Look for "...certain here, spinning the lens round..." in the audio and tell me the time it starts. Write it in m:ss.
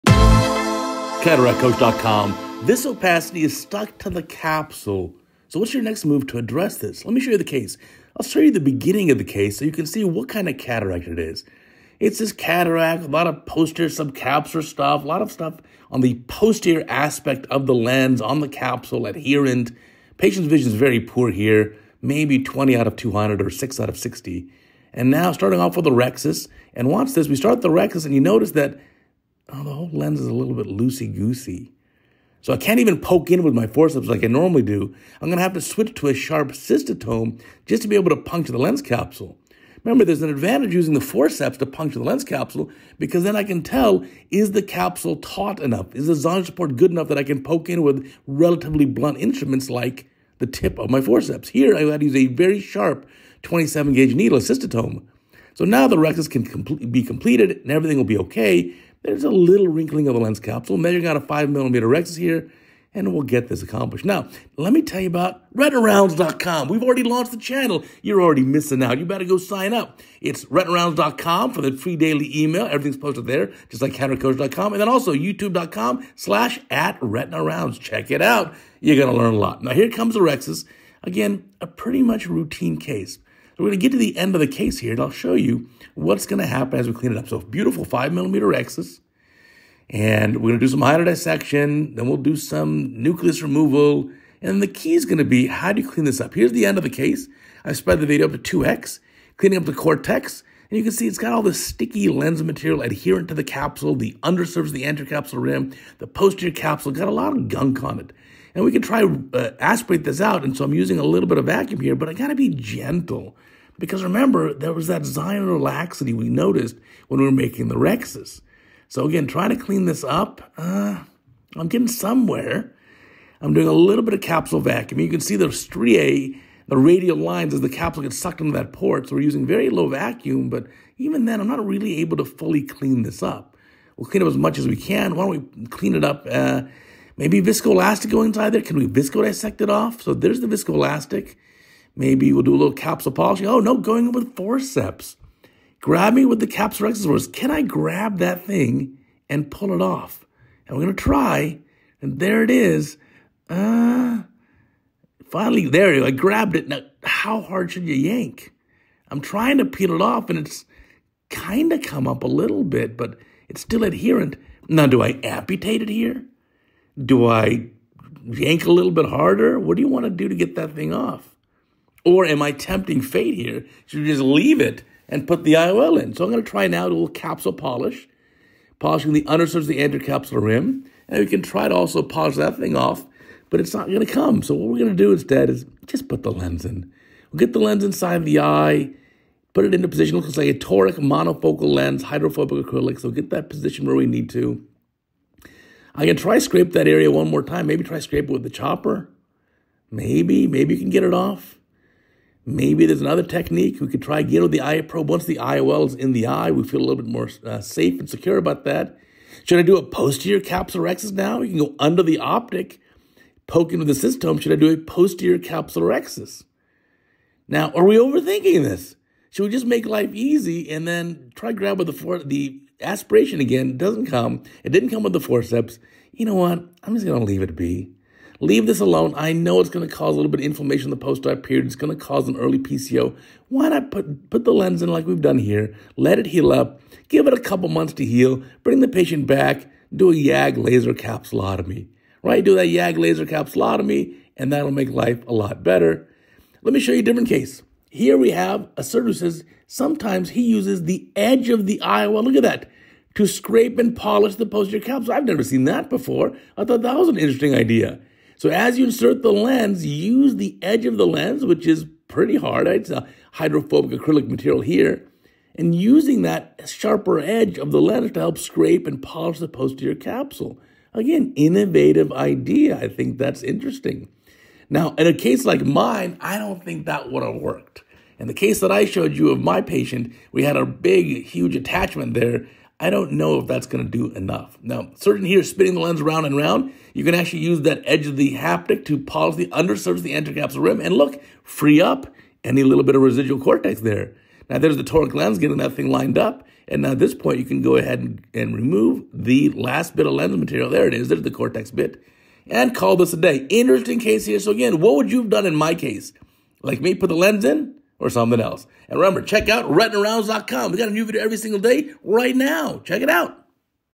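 4:44.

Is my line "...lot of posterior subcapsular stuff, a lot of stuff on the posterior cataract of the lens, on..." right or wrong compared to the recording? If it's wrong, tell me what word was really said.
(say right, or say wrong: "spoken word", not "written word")
wrong: "aspect", not "cataract".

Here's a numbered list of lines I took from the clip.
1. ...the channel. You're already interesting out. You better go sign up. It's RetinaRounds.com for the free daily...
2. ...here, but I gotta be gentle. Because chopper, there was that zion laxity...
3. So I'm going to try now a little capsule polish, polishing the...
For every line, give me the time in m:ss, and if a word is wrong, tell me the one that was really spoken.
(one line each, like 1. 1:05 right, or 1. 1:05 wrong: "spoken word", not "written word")
1. 1:07 wrong: "missing", not "interesting"
2. 1:51 wrong: "remember", not "chopper"
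3. 2:56 right.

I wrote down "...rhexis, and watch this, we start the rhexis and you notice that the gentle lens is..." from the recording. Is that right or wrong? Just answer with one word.
wrong.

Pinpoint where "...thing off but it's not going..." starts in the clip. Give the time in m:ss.
3:02.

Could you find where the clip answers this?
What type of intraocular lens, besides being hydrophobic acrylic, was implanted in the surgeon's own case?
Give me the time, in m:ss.
3:10.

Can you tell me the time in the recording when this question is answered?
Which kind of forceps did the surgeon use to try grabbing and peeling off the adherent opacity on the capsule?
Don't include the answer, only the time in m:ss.
2:26.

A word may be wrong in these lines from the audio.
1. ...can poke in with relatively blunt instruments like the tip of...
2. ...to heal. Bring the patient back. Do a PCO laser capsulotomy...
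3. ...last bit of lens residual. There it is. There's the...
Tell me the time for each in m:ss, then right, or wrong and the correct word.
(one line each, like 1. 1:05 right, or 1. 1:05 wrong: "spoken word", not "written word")
1. 0:47 right
2. 3:57 wrong: "YAG", not "PCO"
3. 4:59 wrong: "material", not "residual".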